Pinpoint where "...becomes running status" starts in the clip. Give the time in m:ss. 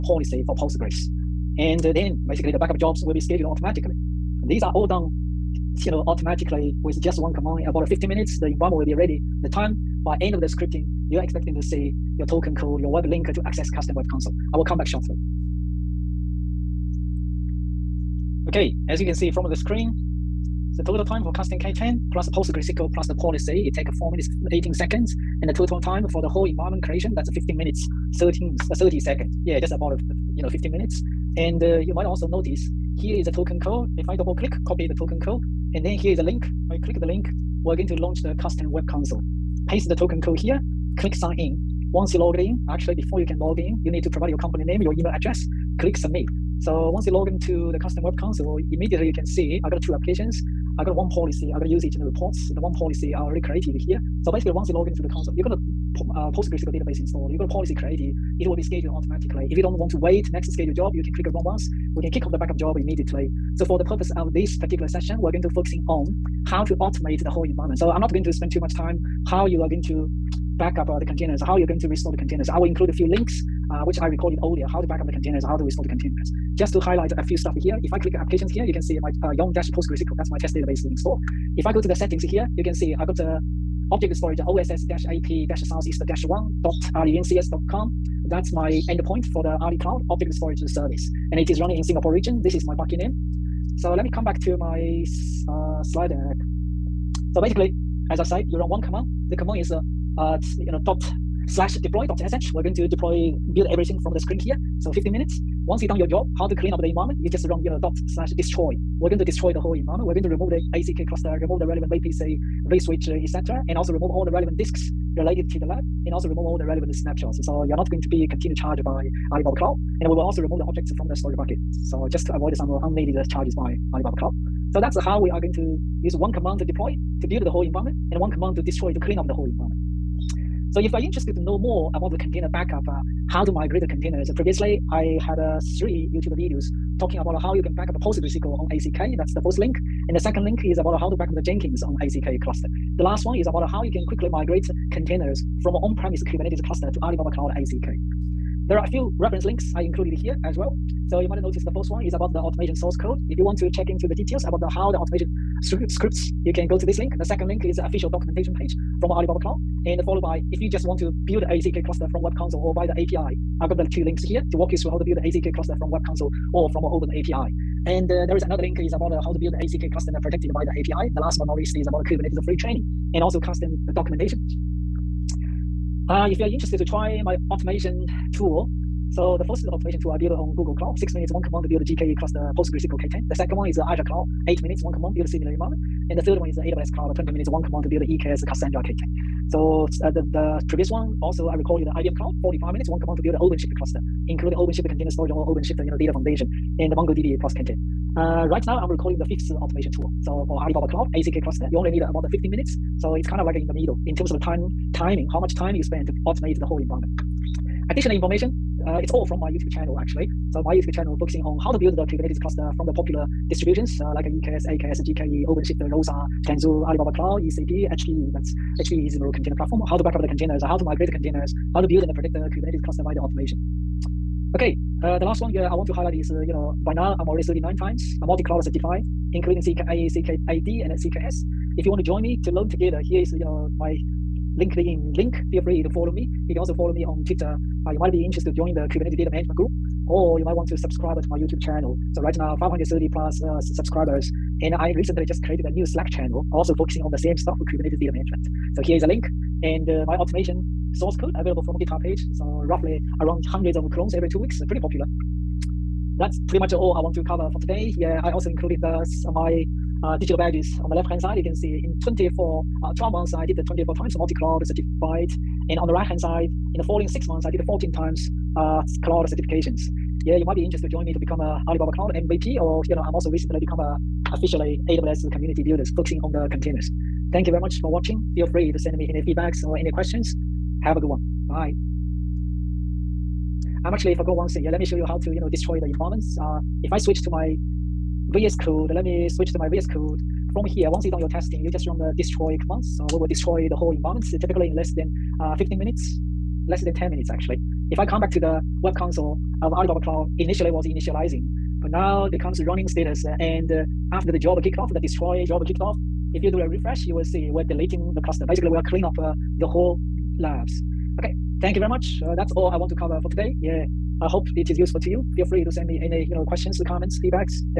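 5:02.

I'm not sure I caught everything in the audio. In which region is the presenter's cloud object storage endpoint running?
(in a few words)
Singapore.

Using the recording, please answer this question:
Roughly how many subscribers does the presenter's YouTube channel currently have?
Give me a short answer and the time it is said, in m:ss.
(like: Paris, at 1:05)
530+, at 4:02.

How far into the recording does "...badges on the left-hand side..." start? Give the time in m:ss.
4:20.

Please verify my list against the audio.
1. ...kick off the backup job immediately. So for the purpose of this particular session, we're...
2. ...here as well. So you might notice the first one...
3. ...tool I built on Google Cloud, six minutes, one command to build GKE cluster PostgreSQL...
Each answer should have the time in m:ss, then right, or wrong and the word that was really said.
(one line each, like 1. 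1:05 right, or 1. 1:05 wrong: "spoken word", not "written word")
1. 1:02 right
2. 2:30 right
3. 3:00 right.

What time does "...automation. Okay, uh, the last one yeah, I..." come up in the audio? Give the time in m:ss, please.
3:43.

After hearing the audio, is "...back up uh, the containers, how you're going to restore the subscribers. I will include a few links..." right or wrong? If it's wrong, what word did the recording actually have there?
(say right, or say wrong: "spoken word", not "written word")
wrong: "containers", not "subscribers".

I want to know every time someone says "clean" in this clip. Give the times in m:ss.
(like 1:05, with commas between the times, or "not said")
1:46, 2:08, 5:08.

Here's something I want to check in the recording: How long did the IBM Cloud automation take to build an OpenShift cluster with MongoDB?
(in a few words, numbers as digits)
45 minutes.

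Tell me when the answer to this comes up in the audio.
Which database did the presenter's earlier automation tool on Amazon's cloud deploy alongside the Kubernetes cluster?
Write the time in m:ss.
3:08.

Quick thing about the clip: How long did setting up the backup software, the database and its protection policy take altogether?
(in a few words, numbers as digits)
4 minutes 18 seconds.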